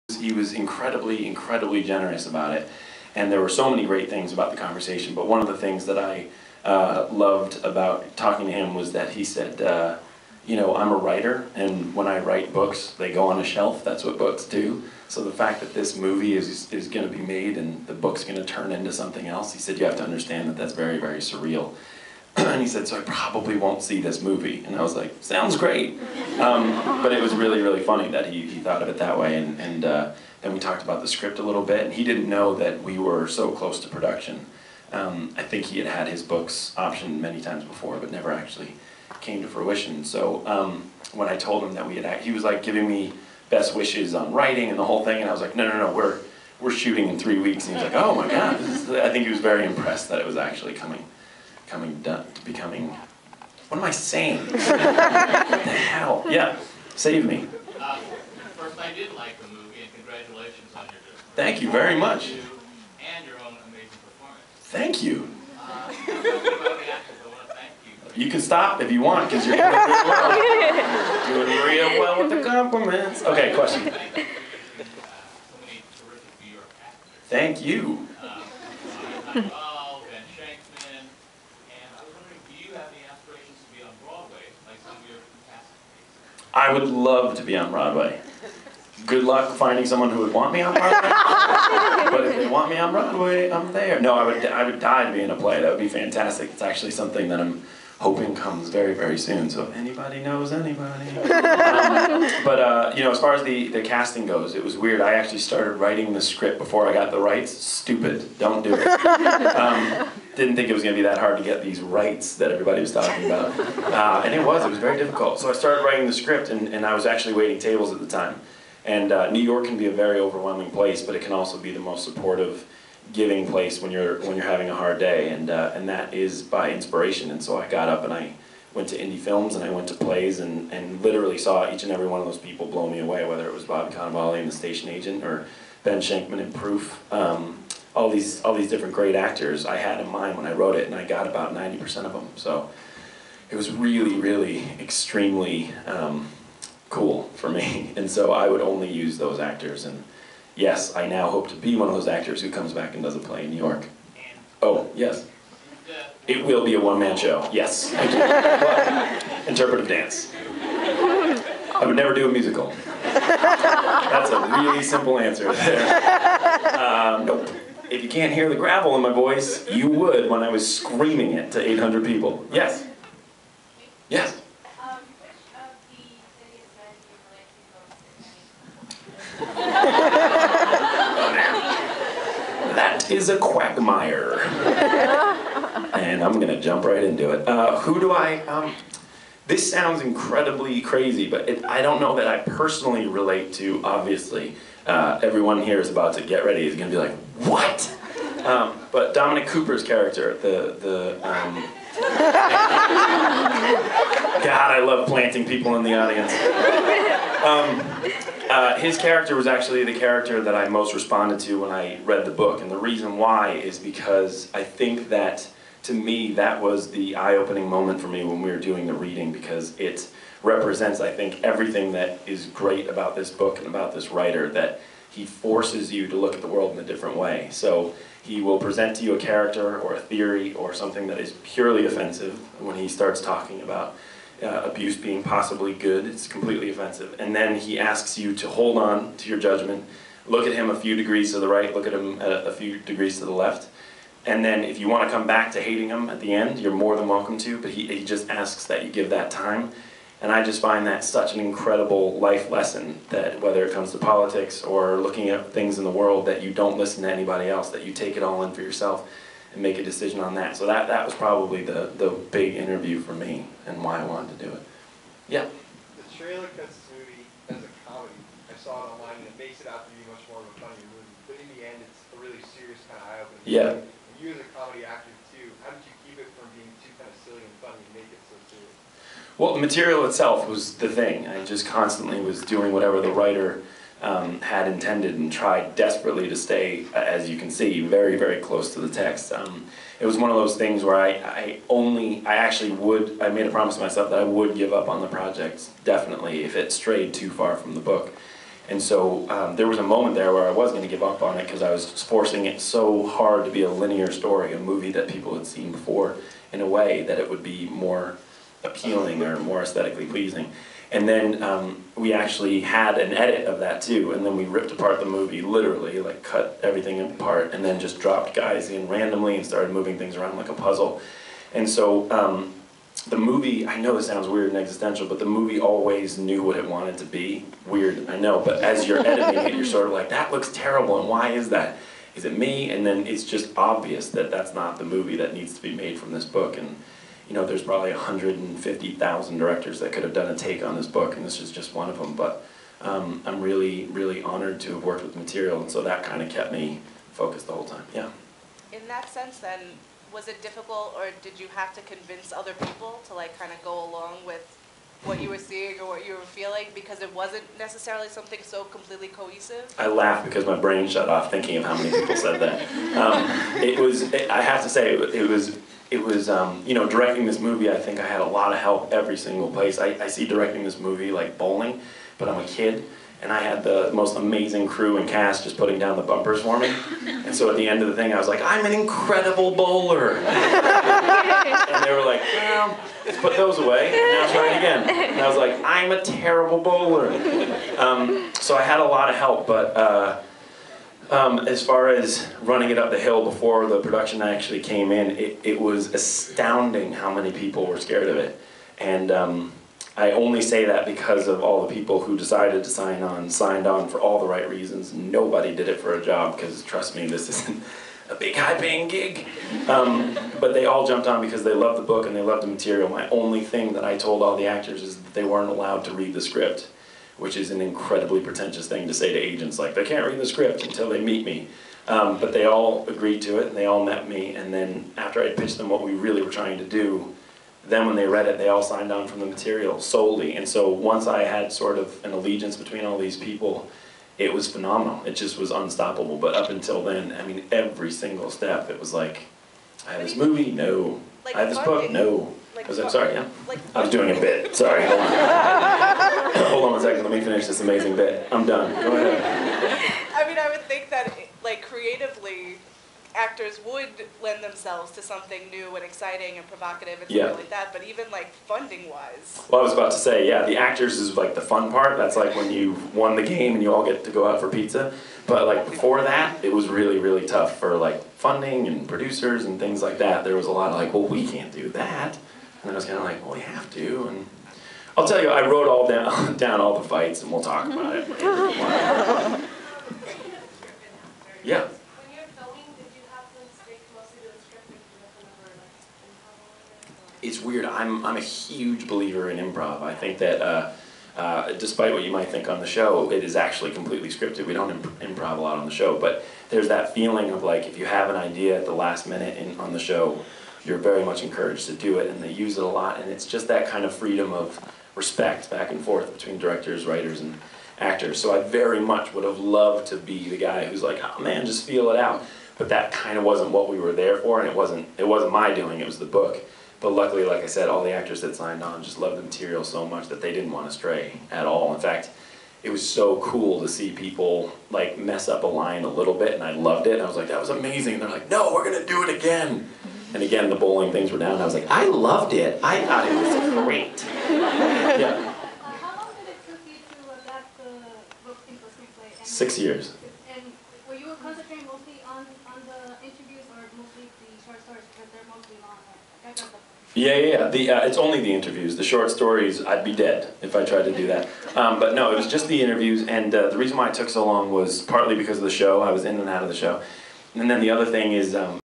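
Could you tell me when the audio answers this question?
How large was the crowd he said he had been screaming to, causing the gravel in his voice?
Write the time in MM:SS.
02:51.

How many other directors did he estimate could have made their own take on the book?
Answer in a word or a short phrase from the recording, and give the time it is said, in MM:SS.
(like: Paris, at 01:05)
150,000, at 05:37.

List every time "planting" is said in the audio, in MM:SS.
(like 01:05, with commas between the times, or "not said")
03:25.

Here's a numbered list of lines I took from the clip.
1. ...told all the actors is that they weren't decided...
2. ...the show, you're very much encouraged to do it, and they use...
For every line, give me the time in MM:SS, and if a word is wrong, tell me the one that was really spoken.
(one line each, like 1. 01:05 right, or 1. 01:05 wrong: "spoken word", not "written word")
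1. 06:53 wrong: "allowed", not "decided"
2. 08:19 right.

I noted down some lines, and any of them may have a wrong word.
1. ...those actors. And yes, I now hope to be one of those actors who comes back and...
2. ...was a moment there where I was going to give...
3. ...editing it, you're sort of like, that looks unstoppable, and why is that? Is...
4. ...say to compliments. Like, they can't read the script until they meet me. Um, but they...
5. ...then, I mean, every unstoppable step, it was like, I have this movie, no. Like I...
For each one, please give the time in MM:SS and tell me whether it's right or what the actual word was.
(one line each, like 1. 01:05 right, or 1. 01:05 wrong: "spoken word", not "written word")
1. 02:29 right
2. 04:59 right
3. 05:28 wrong: "terrible", not "unstoppable"
4. 06:58 wrong: "agents", not "compliments"
5. 07:16 wrong: "single", not "unstoppable".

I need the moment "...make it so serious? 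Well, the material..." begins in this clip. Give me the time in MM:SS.
04:37.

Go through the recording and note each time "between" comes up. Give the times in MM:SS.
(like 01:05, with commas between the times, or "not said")
07:12, 08:26.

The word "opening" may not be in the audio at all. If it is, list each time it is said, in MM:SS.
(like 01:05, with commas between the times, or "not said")
03:37, 04:33.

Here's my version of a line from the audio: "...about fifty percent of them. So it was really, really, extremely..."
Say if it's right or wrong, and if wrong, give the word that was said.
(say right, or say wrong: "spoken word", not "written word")
wrong: "ninety", not "fifty".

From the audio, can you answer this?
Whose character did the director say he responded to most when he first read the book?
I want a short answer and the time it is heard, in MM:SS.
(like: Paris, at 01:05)
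Dominic Cooper, at 03:19.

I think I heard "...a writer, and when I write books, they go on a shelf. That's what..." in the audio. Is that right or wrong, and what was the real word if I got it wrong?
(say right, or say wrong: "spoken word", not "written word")
right.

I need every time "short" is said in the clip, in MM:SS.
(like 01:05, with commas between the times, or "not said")
09:04, 09:08.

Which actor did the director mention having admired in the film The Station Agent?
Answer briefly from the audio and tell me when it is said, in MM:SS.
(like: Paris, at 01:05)
Bob Cannavale, at 02:13.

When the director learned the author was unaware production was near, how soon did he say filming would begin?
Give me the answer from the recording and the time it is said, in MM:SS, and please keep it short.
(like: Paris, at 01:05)
in 3 weeks, at 00:47.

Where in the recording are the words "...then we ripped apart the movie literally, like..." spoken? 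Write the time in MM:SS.
05:14.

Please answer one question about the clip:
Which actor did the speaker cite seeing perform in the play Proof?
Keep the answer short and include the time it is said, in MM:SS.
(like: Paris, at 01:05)
Ben Shenkman, at 02:15.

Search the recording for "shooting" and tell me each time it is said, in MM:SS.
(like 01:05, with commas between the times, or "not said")
00:46.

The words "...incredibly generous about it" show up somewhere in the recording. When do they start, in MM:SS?
00:01.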